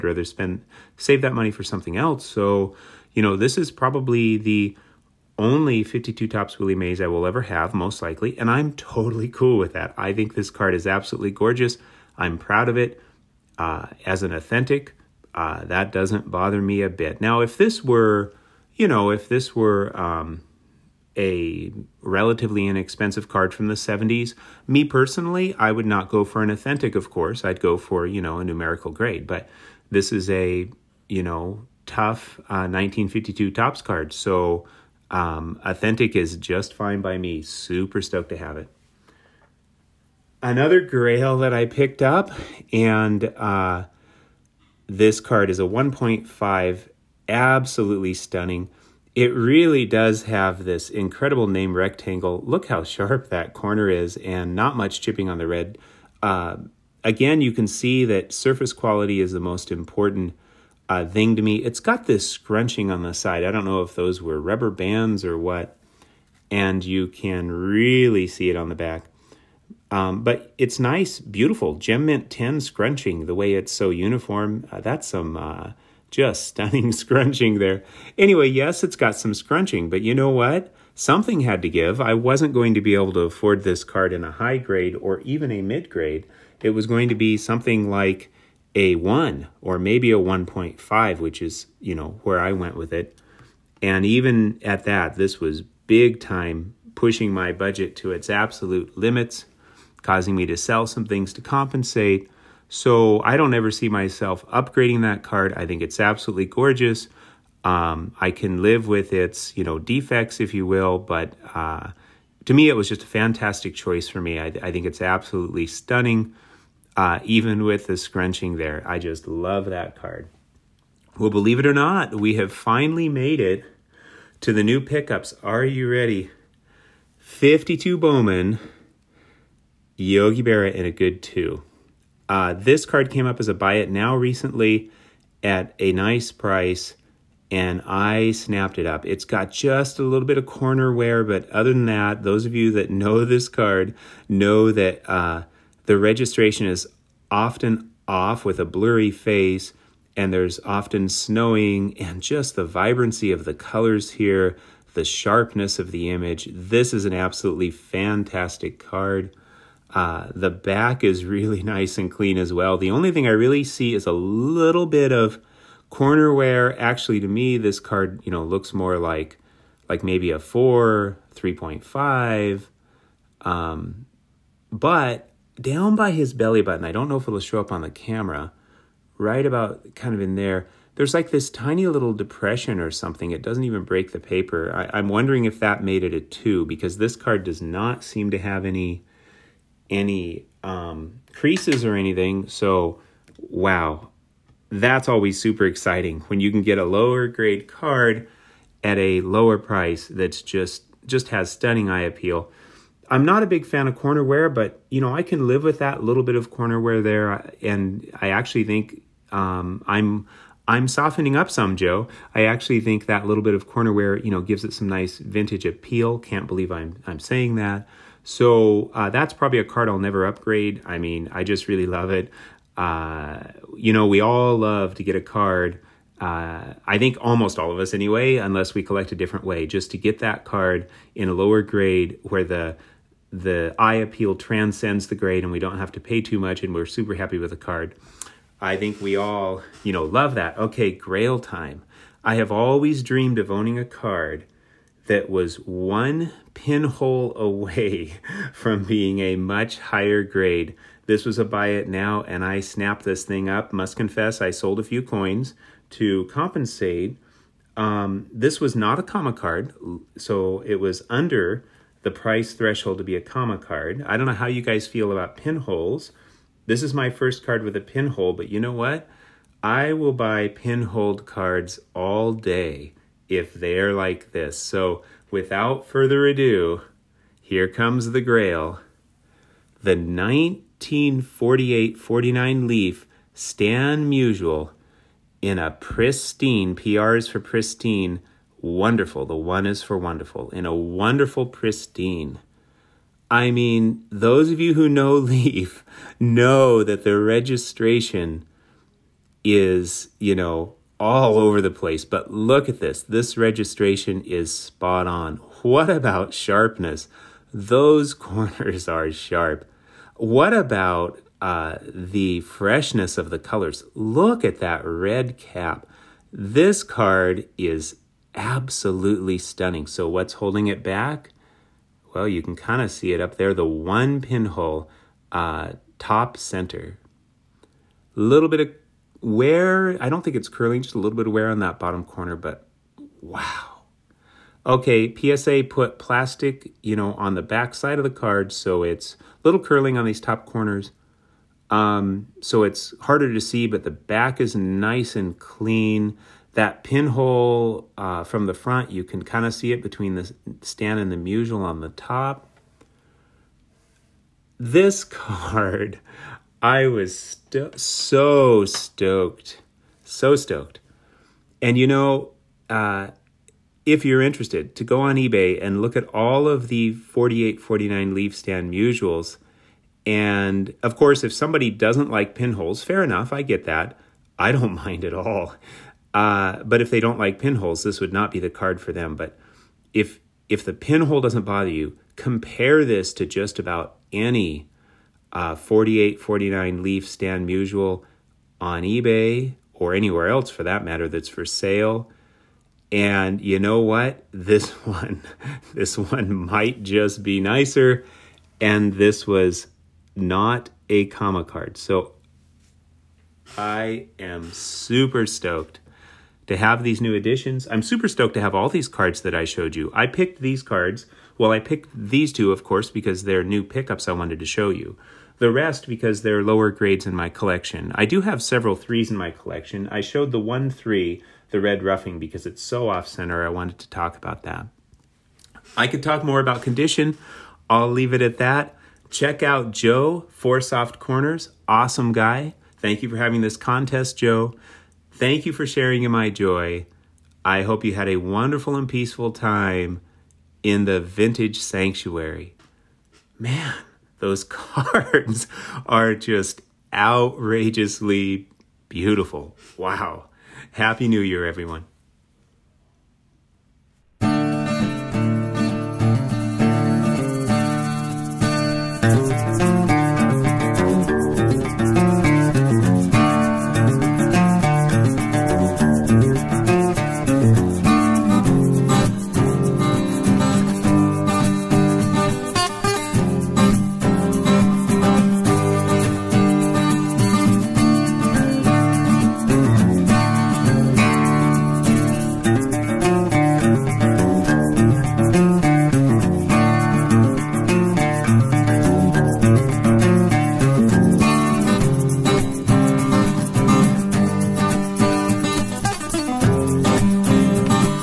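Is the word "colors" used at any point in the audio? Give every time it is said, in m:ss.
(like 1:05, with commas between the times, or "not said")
2:33, 5:13.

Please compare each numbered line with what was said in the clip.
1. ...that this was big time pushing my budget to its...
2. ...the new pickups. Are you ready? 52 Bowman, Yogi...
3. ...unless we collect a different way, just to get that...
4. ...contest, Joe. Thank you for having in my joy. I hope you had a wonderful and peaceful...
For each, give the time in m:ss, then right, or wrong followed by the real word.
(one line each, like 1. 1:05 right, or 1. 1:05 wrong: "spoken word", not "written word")
1. 1:34 right
2. 2:04 right
3. 3:48 right
4. 7:13 wrong: "sharing", not "having".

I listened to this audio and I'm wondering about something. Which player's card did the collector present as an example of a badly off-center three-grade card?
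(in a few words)
Red Ruffing.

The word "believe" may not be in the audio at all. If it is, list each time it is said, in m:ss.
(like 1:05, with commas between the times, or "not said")
2:01, 3:36.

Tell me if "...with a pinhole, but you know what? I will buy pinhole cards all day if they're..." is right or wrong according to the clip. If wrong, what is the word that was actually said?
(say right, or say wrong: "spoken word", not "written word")
right.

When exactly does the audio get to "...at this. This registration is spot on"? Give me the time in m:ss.
5:02.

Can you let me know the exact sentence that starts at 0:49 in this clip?
It really does have this incredible name rectangle.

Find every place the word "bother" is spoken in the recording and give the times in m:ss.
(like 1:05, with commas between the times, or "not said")
0:16, 6:21.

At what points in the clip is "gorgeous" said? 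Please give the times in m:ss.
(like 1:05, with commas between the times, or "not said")
0:11, 1:46.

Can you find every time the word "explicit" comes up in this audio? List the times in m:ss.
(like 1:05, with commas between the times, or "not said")
not said.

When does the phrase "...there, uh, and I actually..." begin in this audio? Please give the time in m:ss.
3:27.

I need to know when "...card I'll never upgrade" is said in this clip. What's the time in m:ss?
3:39.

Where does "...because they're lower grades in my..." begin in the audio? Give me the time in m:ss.
6:55.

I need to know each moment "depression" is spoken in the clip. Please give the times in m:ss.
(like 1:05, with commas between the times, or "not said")
3:02.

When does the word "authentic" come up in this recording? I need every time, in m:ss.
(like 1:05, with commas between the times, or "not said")
0:14, 0:26, 0:35.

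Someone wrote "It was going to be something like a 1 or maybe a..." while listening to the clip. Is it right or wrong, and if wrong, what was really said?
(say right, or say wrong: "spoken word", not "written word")
right.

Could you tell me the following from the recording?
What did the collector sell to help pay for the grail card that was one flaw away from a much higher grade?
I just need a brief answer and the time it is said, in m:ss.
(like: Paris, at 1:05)
coins, at 4:15.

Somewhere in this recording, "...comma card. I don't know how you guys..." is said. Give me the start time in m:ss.
4:23.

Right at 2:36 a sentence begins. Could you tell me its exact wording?
This is an absolutely fantastic card.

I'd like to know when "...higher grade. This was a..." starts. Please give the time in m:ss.
4:09.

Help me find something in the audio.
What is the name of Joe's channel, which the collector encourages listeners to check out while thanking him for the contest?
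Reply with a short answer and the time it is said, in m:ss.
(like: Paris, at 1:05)
Four Soft Corners, at 7:10.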